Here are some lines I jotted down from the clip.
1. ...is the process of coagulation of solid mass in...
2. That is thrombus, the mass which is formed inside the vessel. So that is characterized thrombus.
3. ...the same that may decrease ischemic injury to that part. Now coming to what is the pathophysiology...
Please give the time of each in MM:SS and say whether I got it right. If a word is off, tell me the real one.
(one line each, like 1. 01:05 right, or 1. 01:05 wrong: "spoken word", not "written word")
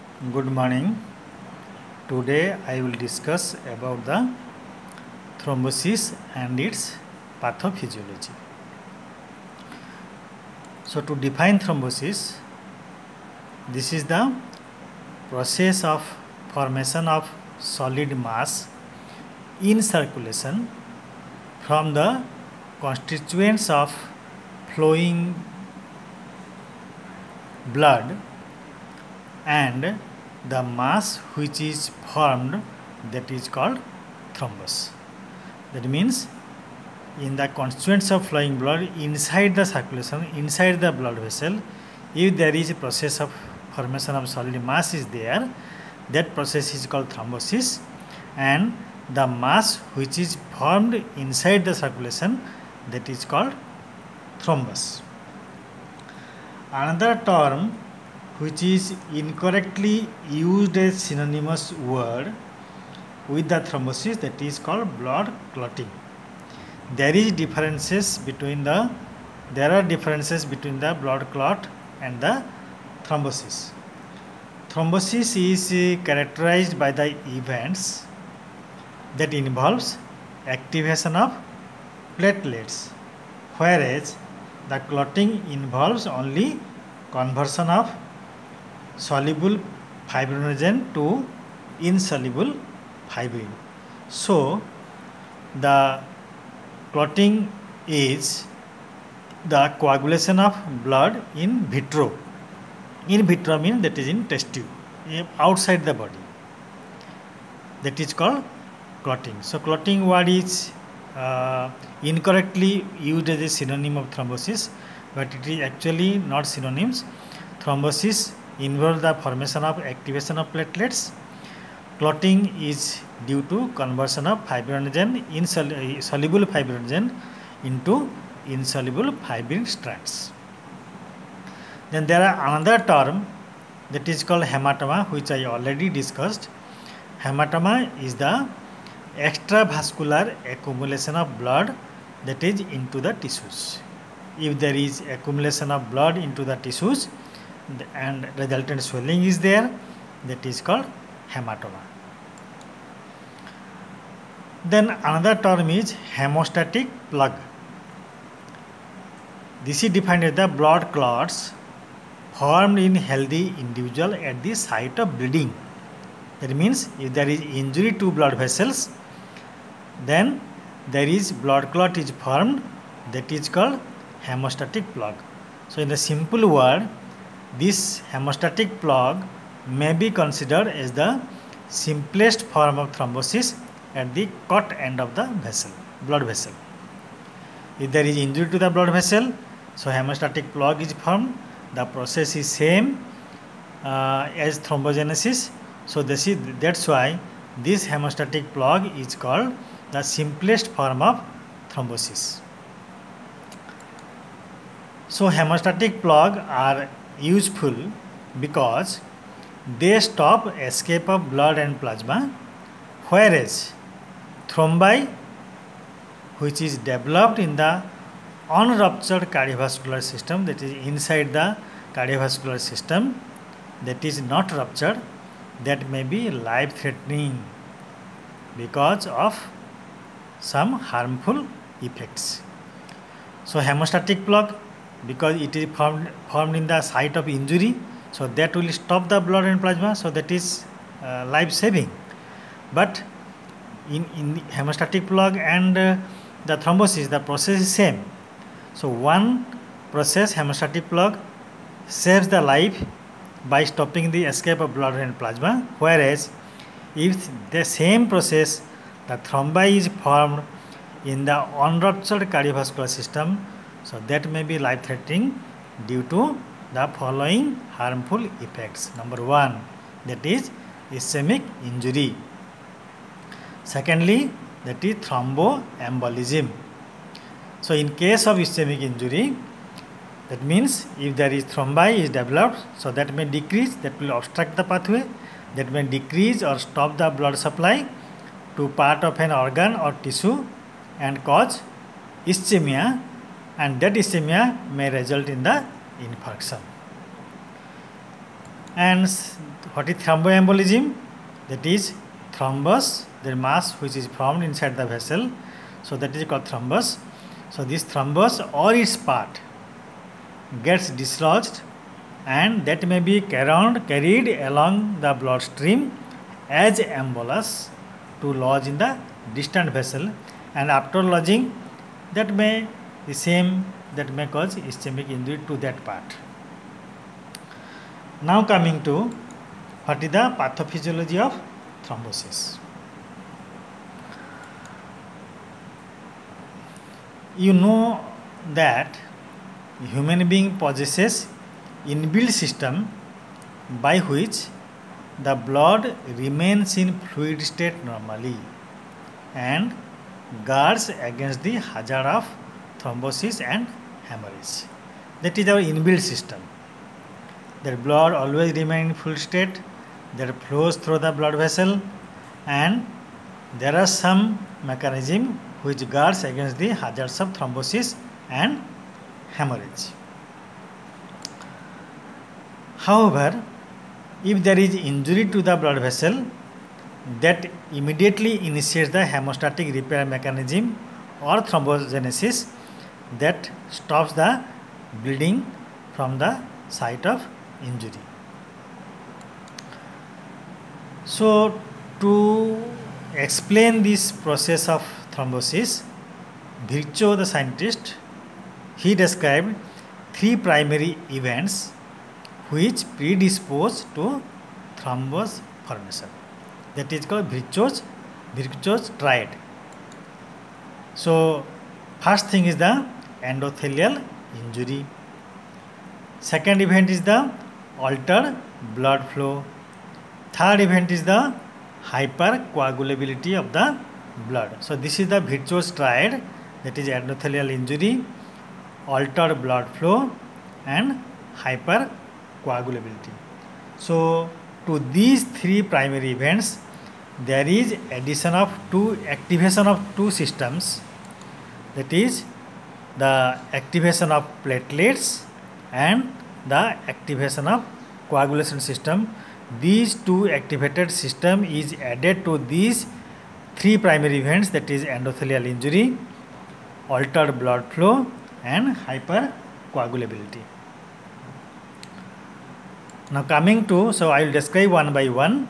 1. 00:13 wrong: "formation", not "coagulation"
2. 05:01 wrong: "called", not "characterized"
3. 05:23 wrong: "cause", not "decrease".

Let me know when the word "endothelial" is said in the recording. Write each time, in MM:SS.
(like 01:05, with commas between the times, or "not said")
06:53, 07:06, 07:34.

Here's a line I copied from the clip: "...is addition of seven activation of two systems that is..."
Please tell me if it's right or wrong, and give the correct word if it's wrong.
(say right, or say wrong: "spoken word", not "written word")
wrong: "two", not "seven".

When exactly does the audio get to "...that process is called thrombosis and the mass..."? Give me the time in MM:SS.
00:46.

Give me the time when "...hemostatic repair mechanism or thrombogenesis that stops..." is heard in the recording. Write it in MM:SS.
06:19.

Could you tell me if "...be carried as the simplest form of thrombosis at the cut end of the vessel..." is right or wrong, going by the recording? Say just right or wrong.
wrong.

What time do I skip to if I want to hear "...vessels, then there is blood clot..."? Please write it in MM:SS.
02:48.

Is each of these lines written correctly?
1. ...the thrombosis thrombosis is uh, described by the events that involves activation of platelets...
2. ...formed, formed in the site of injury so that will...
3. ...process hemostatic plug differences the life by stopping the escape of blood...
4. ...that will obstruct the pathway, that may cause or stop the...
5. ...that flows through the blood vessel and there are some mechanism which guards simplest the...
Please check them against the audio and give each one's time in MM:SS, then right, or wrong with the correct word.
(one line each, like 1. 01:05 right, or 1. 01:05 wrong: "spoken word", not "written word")
1. 01:12 wrong: "characterized", not "described"
2. 03:55 right
3. 04:09 wrong: "saves", not "differences"
4. 04:43 wrong: "decrease", not "cause"
5. 06:00 wrong: "against", not "simplest".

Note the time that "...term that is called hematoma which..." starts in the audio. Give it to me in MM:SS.
02:12.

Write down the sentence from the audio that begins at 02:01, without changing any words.
Clotting is due to conversion of fibrinogen insoluble fibrinogen into insoluble fibrin strands.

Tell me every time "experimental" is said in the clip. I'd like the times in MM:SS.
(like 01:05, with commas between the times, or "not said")
not said.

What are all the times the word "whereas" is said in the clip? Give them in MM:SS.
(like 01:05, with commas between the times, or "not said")
01:23, 03:33, 04:15.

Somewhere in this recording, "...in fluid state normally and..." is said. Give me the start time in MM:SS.
05:46.